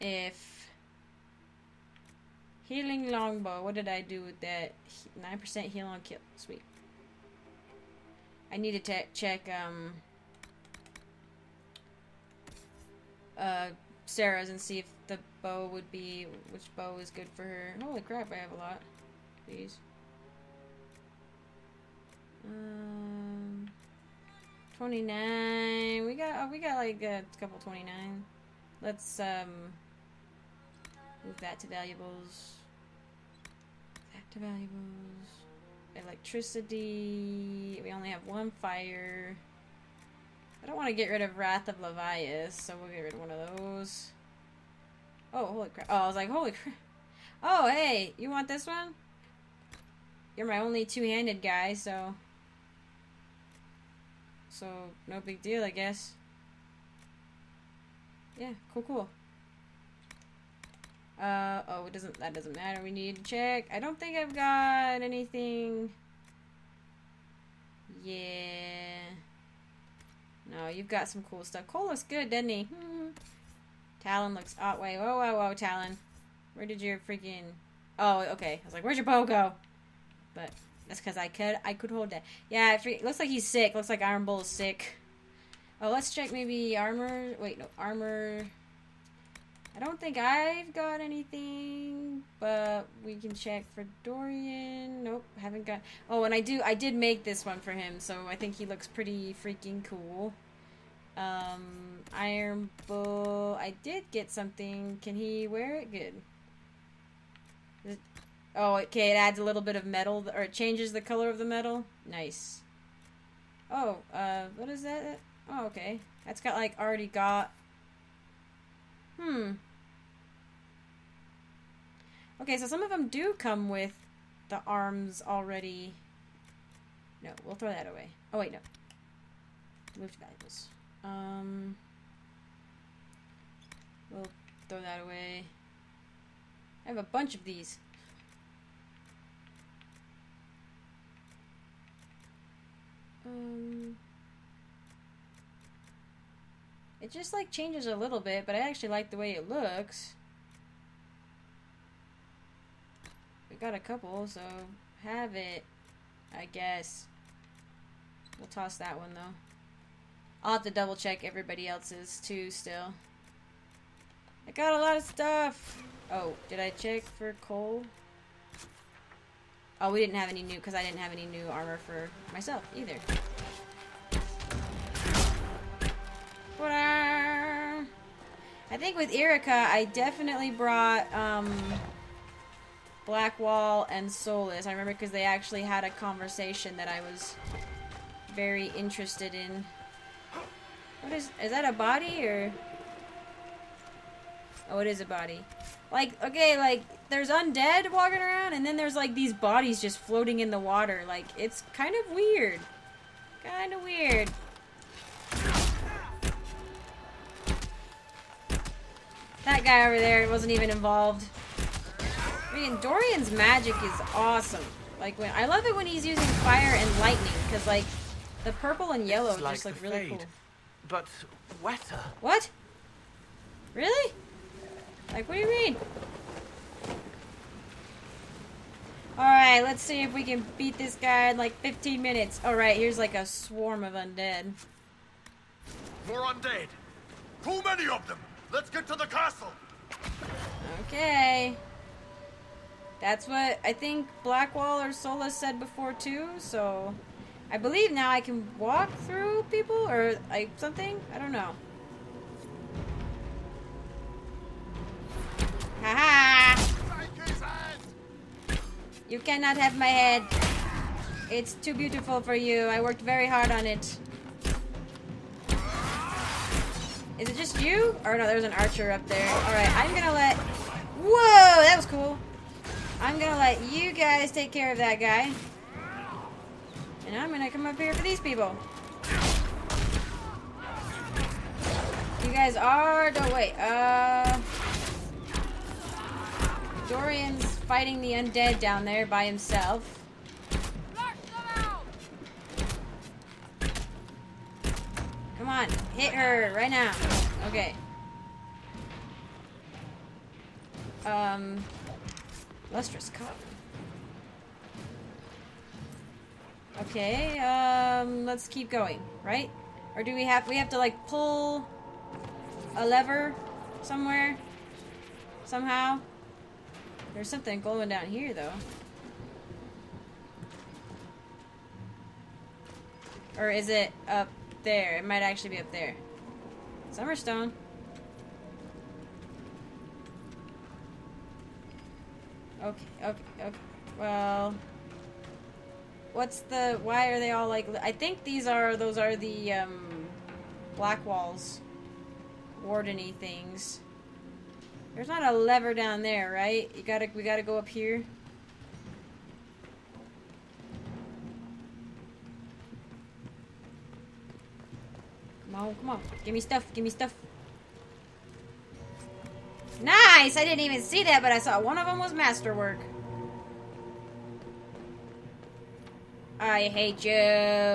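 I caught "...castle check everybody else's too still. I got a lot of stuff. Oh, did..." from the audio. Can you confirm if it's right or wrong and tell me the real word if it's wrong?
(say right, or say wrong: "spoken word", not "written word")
wrong: "double", not "castle".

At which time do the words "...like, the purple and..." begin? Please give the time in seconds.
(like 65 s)
217 s.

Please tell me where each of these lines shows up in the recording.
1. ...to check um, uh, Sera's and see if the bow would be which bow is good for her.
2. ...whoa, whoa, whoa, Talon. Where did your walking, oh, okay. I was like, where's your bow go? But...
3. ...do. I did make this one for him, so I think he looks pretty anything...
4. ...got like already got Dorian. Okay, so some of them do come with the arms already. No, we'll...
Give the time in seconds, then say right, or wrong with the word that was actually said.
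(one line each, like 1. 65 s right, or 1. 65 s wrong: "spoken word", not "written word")
1. 8 s right
2. 74 s wrong: "freaking", not "walking"
3. 96 s wrong: "freaking", not "anything"
4. 116 s wrong: "Hmm", not "Dorian".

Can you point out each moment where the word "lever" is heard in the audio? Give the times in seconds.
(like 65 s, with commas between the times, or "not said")
312 s, 345 s.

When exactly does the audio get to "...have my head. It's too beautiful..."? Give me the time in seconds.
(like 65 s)
259 s.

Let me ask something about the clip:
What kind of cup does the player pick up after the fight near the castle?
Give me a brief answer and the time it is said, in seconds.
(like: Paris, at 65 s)
lustrous cup, at 302 s.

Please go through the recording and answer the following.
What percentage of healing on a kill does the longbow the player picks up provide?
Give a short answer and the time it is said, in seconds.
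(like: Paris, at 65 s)
9%, at 5 s.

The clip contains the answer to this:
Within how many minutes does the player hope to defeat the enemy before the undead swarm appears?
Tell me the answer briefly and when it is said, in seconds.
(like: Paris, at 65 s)
15, at 231 s.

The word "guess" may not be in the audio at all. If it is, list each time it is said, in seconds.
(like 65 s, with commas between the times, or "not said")
55 s, 156 s.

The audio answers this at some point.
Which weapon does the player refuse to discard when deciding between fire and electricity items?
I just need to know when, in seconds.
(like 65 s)
41 s.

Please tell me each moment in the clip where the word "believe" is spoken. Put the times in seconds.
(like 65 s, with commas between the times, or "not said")
247 s.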